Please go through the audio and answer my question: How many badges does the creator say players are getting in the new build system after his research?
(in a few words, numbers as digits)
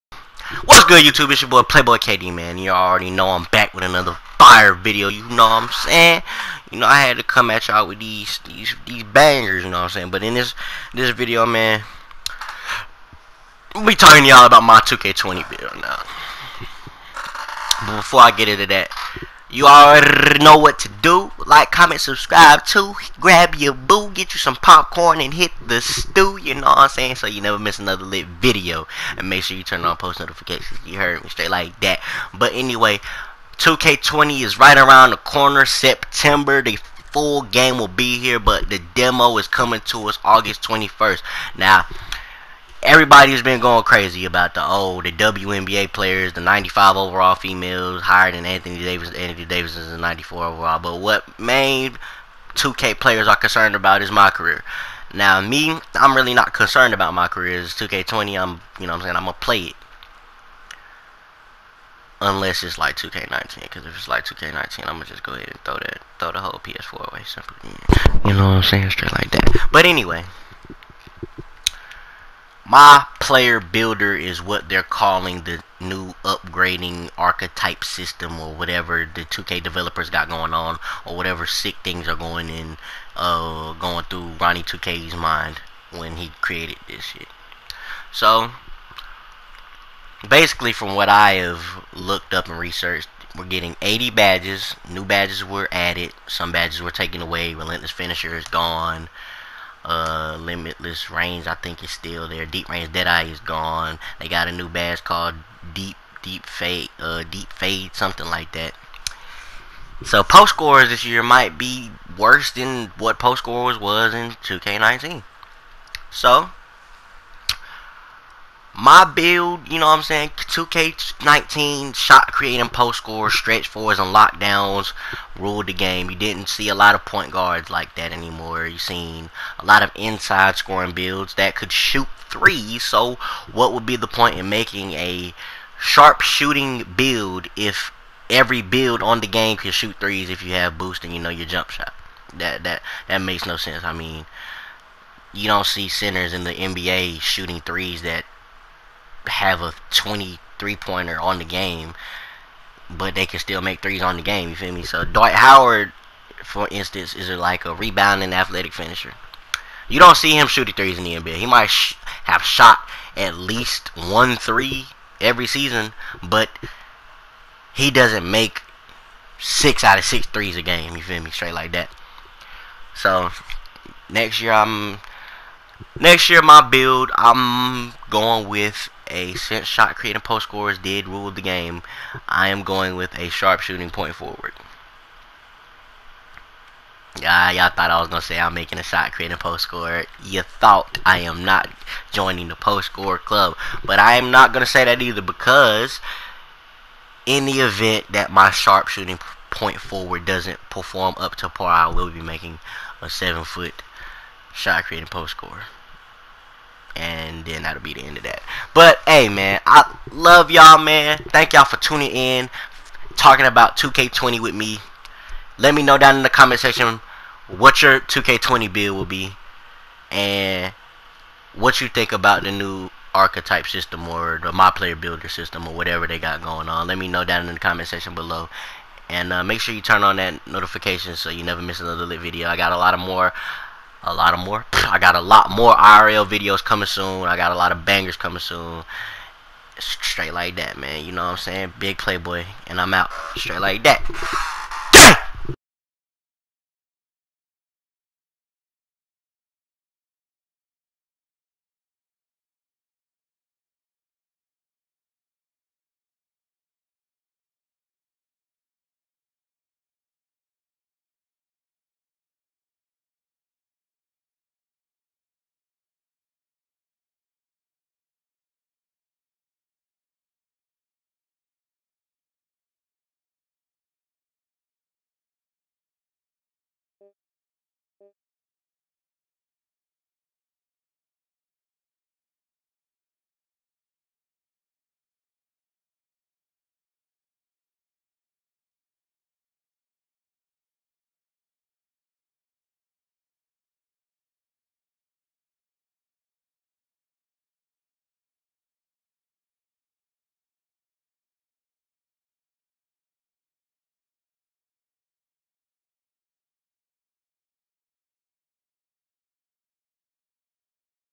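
80.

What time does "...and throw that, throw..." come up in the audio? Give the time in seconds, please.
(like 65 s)
65 s.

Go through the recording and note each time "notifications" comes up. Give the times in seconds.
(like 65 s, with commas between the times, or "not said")
30 s, 230 s.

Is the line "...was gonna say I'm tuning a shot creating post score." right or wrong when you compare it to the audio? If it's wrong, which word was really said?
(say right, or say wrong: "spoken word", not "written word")
wrong: "making", not "tuning".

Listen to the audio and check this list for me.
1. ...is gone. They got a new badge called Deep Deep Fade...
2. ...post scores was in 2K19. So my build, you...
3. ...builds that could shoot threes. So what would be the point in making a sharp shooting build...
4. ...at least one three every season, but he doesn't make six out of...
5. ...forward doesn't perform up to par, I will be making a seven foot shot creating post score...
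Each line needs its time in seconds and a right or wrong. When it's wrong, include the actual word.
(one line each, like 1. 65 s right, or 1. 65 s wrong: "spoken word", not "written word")
1. 103 s right
2. 113 s right
3. 130 s right
4. 163 s right
5. 199 s right.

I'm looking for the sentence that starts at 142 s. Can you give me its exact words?
That that that makes no sense.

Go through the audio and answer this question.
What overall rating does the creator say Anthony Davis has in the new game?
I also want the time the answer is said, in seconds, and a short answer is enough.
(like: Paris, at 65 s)
94, at 49 s.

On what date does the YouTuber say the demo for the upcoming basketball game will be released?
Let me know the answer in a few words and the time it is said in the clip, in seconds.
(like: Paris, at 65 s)
August 21, at 40 s.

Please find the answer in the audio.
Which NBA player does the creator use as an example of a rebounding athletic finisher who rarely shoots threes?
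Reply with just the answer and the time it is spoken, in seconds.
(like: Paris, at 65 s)
Dwight Howard, at 155 s.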